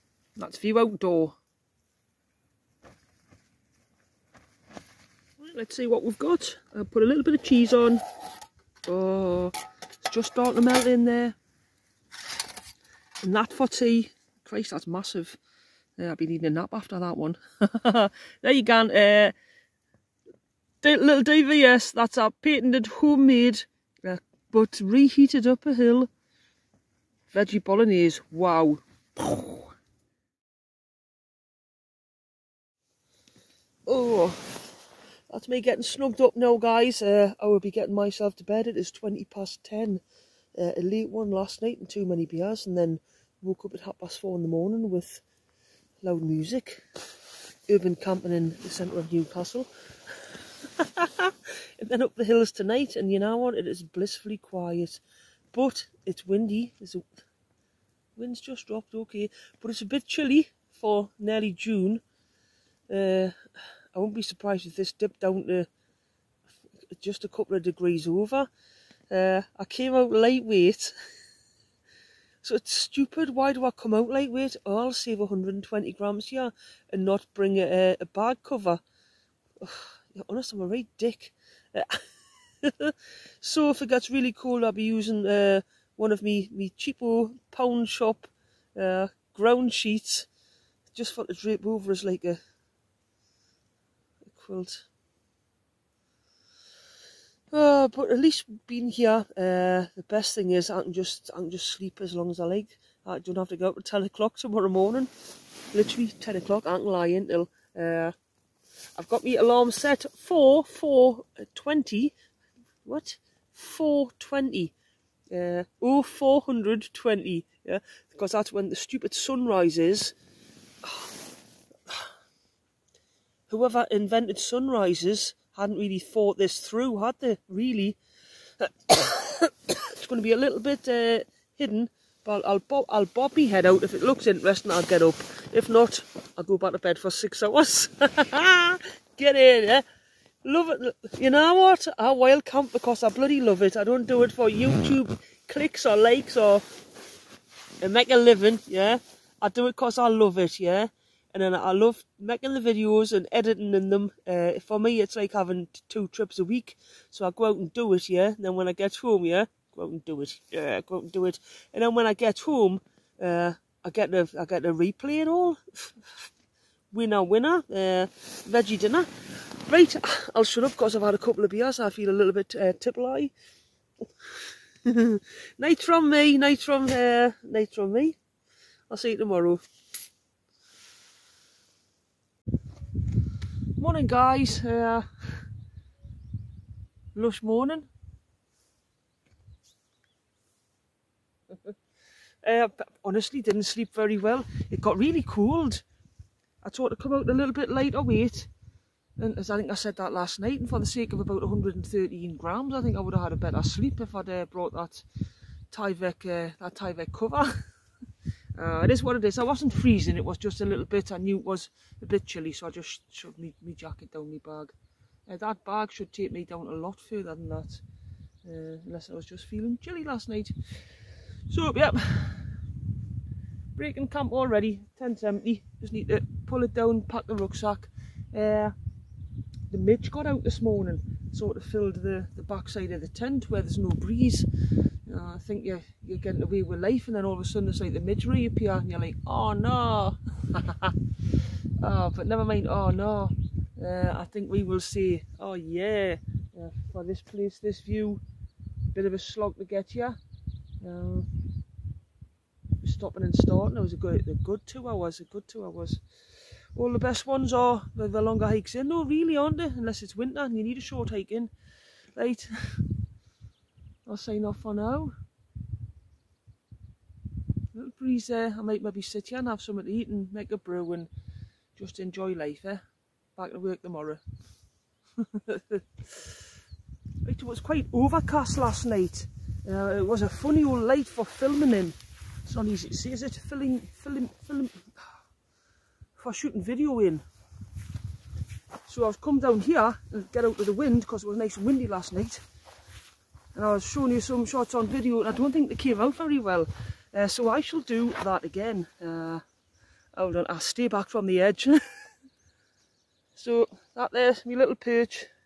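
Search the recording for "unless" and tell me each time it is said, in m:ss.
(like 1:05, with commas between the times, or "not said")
3:38, 4:19.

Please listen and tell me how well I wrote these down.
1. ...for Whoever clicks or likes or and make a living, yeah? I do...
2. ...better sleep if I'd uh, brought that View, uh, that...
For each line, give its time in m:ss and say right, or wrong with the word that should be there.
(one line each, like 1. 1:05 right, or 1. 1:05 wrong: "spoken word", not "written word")
1. 2:24 wrong: "YouTube", not "Whoever"
2. 3:23 wrong: "Tyvek", not "View".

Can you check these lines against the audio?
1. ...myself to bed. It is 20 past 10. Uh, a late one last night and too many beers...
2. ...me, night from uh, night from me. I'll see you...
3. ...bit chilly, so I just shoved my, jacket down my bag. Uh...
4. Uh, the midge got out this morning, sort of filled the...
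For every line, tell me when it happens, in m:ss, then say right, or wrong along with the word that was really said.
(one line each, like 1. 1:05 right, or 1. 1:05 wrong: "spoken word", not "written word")
1. 0:37 right
2. 2:56 right
3. 3:32 right
4. 3:48 right.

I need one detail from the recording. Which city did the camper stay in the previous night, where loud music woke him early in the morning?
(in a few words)
Newcastle.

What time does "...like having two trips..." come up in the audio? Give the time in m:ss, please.
2:35.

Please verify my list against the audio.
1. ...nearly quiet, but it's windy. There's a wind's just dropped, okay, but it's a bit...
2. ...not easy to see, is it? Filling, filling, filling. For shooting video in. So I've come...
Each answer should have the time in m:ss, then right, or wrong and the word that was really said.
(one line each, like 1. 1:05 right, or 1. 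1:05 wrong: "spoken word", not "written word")
1. 0:53 wrong: "blissfully", not "nearly"
2. 4:42 right.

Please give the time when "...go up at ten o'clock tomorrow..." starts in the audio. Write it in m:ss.
1:43.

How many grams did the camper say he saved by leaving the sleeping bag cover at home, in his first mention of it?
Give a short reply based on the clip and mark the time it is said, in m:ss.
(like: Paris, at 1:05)
120, at 1:15.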